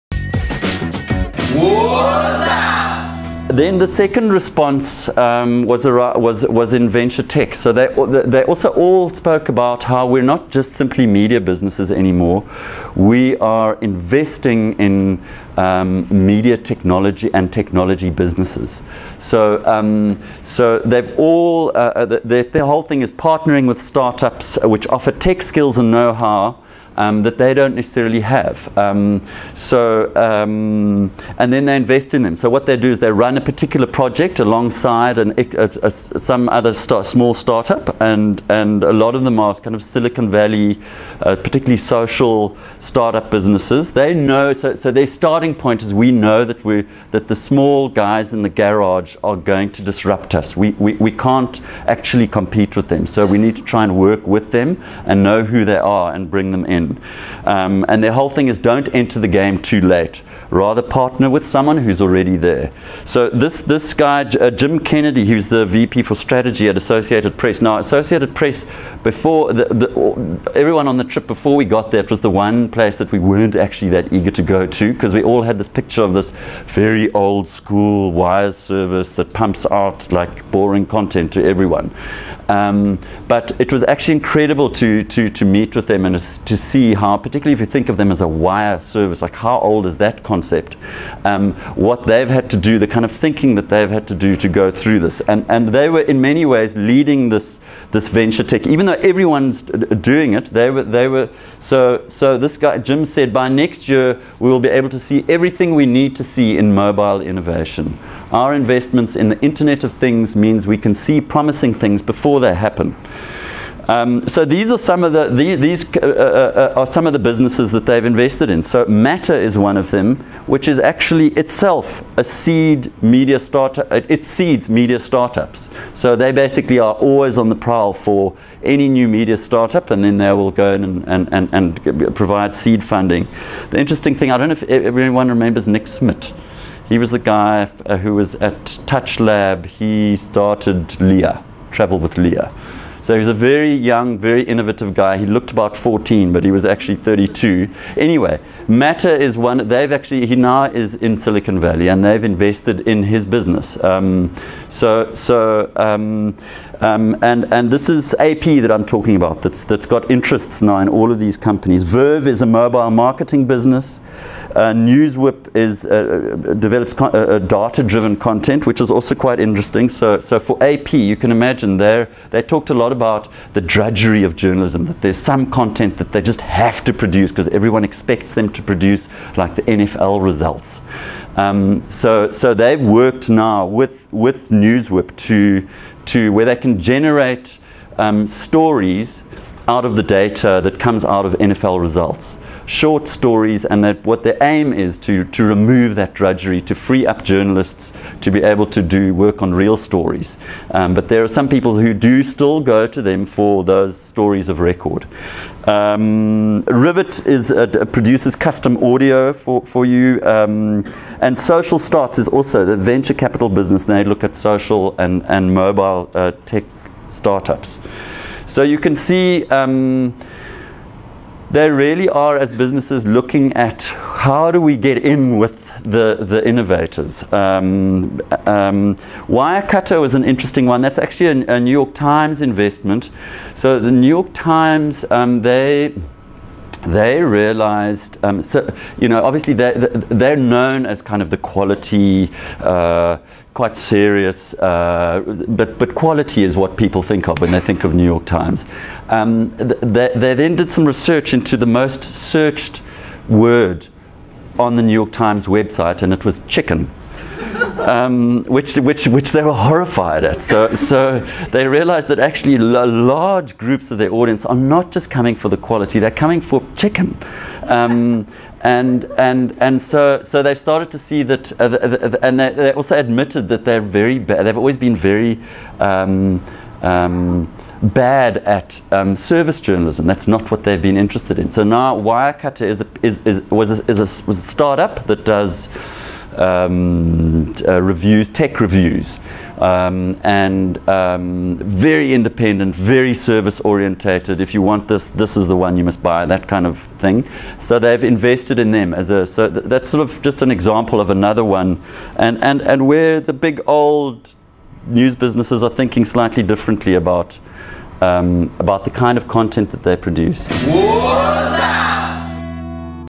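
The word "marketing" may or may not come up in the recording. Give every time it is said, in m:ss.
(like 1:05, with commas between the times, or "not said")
2:42.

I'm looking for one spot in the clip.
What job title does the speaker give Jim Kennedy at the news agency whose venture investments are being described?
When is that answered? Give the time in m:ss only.
1:05.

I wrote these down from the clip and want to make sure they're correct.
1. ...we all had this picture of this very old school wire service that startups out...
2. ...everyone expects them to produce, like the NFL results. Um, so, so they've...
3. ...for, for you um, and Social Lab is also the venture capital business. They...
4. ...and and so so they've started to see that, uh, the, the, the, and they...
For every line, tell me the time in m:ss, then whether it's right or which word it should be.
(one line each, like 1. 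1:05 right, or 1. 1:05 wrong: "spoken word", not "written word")
1. 1:15 wrong: "pumps", not "startups"
2. 2:57 right
3. 3:29 wrong: "Starts", not "Lab"
4. 4:29 right.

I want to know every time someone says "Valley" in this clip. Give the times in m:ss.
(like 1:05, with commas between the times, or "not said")
0:40, 2:31.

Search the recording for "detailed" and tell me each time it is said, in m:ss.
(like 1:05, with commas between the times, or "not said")
not said.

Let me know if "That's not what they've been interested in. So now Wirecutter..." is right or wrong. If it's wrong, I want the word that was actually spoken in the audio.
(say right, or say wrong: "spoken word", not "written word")
right.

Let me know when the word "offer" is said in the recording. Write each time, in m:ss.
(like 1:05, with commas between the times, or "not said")
0:24.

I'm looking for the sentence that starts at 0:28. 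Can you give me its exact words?
Um, so, um, and then they invest in them.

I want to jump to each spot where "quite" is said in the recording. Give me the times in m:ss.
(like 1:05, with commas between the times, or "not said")
2:49, 4:03.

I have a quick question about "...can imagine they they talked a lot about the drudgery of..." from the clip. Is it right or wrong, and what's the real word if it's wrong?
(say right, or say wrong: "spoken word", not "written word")
right.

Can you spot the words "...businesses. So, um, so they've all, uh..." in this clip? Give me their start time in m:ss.
0:18.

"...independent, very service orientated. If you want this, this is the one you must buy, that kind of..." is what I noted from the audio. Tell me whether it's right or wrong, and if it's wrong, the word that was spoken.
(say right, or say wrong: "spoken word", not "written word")
right.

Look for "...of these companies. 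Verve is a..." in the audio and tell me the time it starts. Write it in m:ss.
2:41.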